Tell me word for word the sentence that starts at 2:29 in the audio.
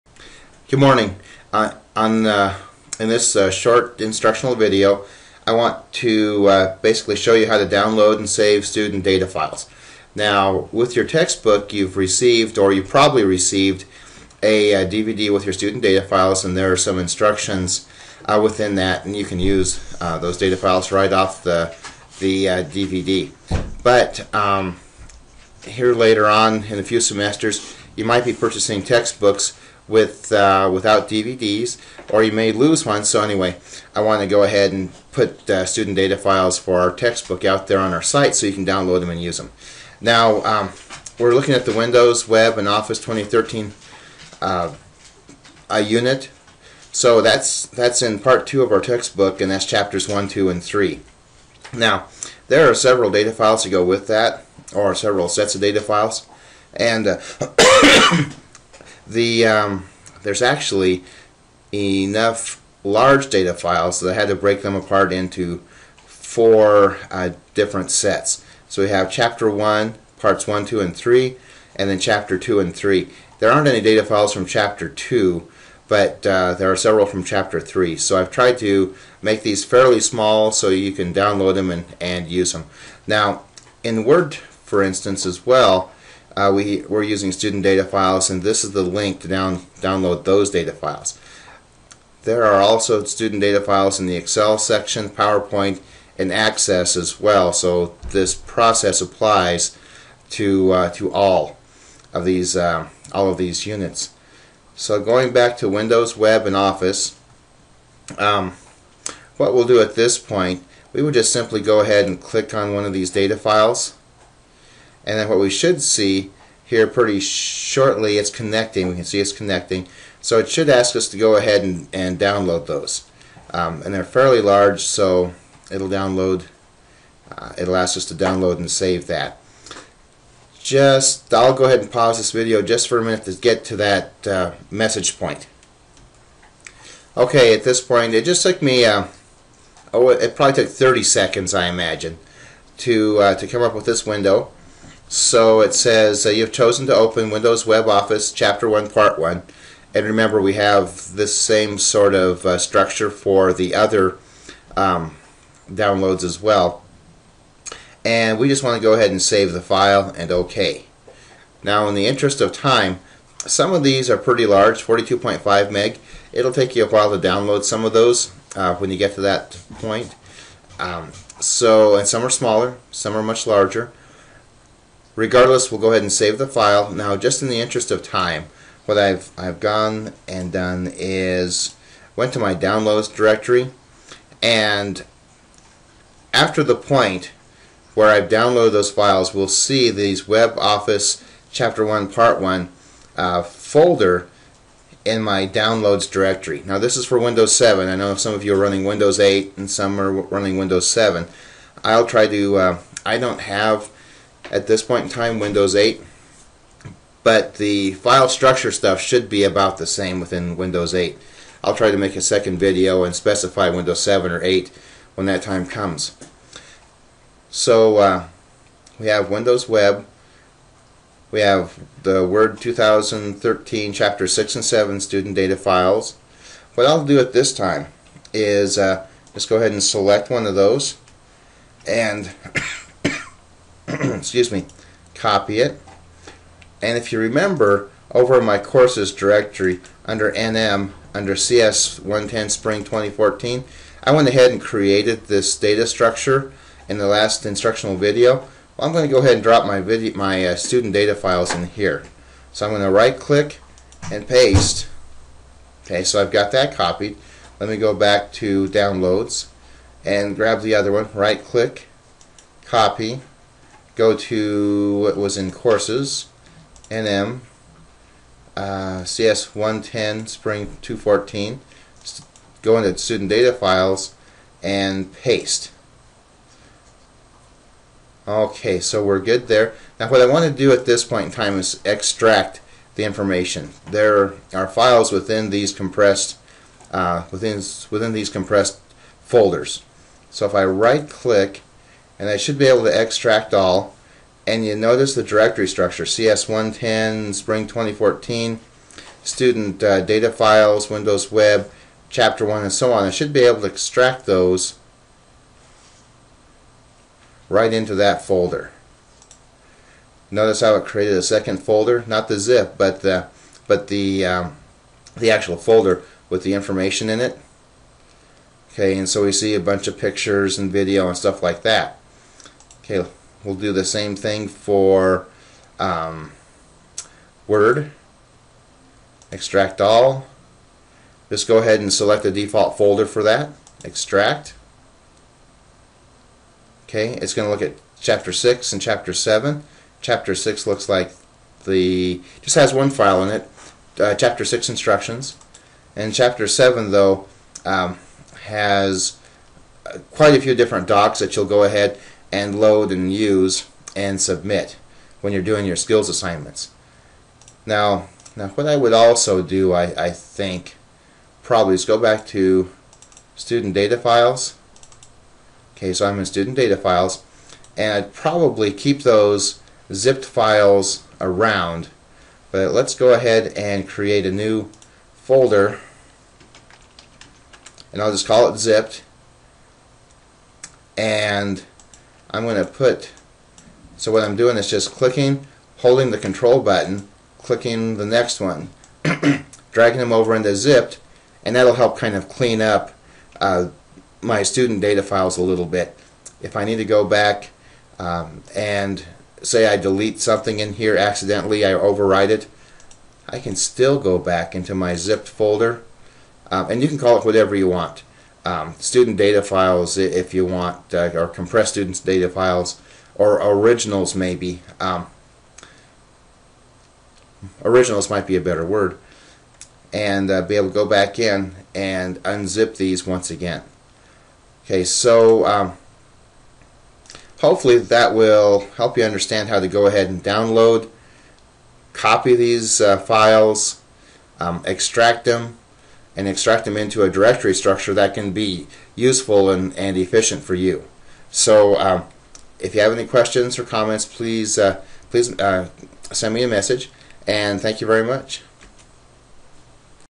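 And remember, we have this same sort of uh, structure for the other um, downloads as well.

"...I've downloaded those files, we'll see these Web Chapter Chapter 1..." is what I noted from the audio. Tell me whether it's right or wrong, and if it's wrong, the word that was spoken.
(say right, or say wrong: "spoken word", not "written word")
wrong: "Office", not "Chapter".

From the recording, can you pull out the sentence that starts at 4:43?
There are files within these compressed uh, within within these compressed folders.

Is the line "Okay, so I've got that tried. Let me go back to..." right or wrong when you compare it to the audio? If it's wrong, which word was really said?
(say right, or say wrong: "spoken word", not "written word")
wrong: "copied", not "tried".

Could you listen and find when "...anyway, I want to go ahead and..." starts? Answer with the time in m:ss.
0:33.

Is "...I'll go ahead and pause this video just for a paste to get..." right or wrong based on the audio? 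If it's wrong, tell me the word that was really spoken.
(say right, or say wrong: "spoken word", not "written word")
wrong: "minute", not "paste".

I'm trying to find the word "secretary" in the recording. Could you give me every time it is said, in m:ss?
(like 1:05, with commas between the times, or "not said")
not said.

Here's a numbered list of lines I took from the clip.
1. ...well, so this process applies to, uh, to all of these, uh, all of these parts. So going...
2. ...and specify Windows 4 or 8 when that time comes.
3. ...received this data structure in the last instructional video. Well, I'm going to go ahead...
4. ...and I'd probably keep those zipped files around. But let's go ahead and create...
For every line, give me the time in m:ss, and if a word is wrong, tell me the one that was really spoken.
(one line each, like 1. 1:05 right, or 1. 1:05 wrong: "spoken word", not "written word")
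1. 1:37 wrong: "units", not "parts"
2. 3:33 wrong: "7", not "4"
3. 4:04 wrong: "created", not "received"
4. 6:07 right.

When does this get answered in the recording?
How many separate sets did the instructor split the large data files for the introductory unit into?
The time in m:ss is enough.
1:05.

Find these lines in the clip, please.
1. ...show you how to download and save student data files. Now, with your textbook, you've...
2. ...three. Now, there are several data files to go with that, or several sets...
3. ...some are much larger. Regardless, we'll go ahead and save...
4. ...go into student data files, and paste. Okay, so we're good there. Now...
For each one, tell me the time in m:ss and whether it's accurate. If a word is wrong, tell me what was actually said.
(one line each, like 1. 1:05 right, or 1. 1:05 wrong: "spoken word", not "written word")
1. 0:07 right
2. 0:50 right
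3. 2:52 right
4. 4:32 right.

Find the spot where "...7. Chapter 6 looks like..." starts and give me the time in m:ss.
5:39.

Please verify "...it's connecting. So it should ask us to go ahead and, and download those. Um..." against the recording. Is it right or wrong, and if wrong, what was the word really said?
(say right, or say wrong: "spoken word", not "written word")
right.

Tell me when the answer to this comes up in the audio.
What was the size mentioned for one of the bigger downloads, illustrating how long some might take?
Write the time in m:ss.
2:44.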